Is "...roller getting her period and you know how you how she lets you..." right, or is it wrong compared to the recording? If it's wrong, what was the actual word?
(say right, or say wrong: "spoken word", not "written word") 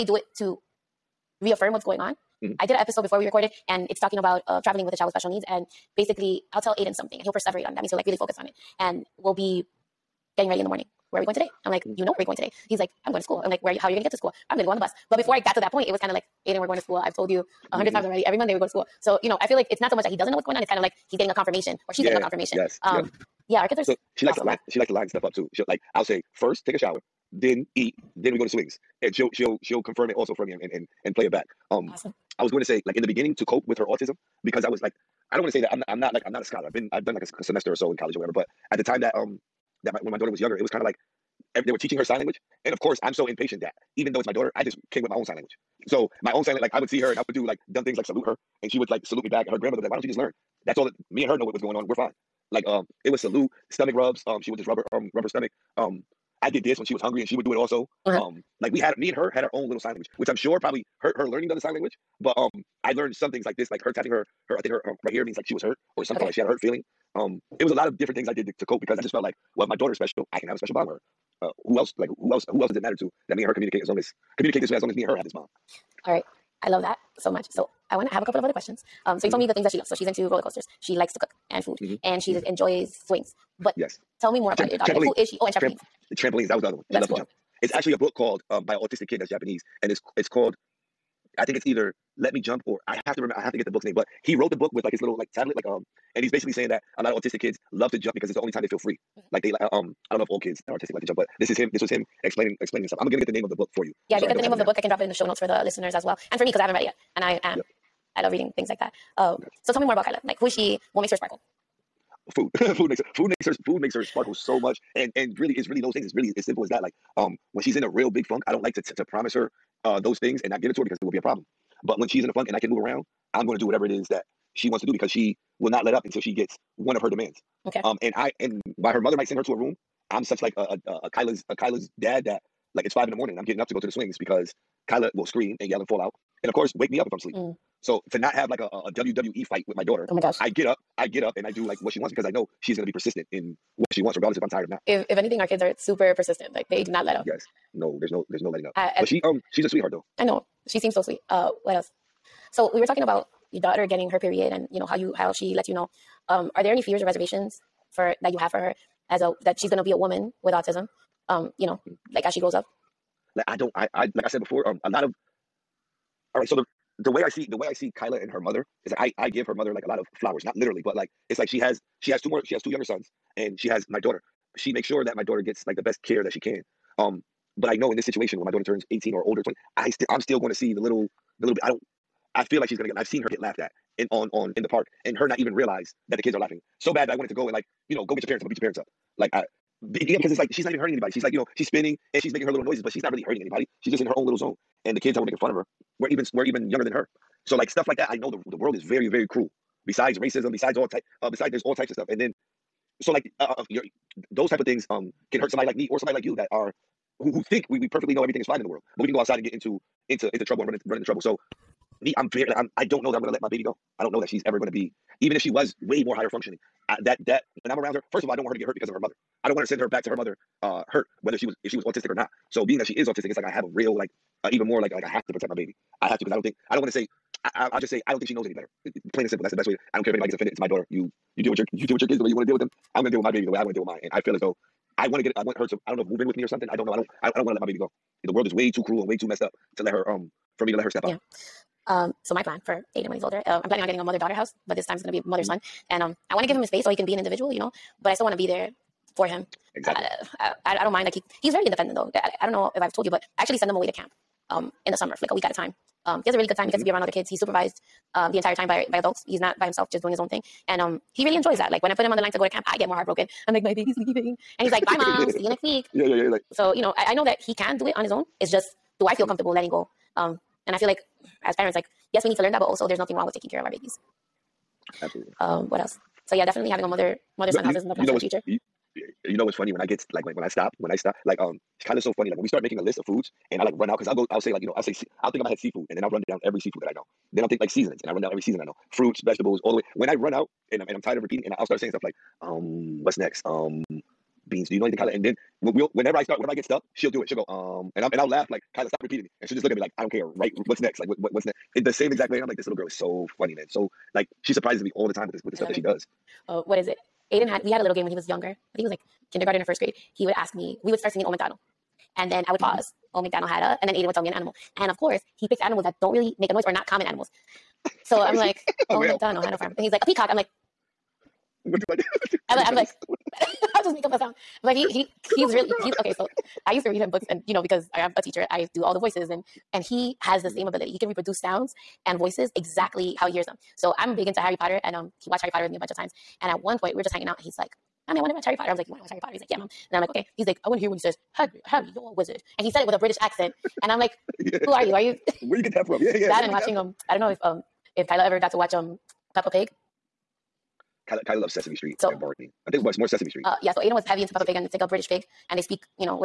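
wrong: "daughter", not "roller".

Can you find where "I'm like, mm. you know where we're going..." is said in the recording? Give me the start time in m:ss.
0:11.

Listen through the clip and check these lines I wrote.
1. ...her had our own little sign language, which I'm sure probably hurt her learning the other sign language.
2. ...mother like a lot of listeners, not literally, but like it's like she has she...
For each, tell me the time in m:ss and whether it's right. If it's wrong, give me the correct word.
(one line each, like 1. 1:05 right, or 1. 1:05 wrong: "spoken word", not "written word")
1. 0:59 right
2. 2:49 wrong: "flowers", not "listeners".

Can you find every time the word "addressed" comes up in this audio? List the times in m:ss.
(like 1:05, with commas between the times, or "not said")
not said.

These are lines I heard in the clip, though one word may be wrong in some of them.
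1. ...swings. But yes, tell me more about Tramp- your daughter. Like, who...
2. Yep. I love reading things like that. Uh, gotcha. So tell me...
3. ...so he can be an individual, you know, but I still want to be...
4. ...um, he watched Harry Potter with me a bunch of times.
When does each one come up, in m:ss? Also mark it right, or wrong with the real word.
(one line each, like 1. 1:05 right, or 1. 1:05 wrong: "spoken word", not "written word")
1. 1:23 right
2. 1:47 right
3. 4:06 right
4. 5:34 right.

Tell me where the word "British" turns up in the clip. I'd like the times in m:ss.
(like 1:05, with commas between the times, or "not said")
5:42, 5:54.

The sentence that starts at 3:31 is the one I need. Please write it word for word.
So me, I'm very like I'm I don't know that I'm gonna let my baby go.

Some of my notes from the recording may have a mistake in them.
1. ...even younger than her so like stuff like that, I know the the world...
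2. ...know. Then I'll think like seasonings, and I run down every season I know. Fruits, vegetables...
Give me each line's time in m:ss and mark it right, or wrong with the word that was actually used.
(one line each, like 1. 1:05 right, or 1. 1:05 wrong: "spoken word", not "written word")
1. 3:16 right
2. 4:46 right.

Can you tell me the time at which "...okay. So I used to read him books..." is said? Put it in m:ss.
5:25.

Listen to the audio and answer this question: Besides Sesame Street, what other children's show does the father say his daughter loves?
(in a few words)
Barney.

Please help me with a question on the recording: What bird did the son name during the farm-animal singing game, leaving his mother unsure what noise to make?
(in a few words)
Peacock.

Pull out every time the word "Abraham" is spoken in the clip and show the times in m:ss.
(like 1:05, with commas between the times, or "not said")
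not said.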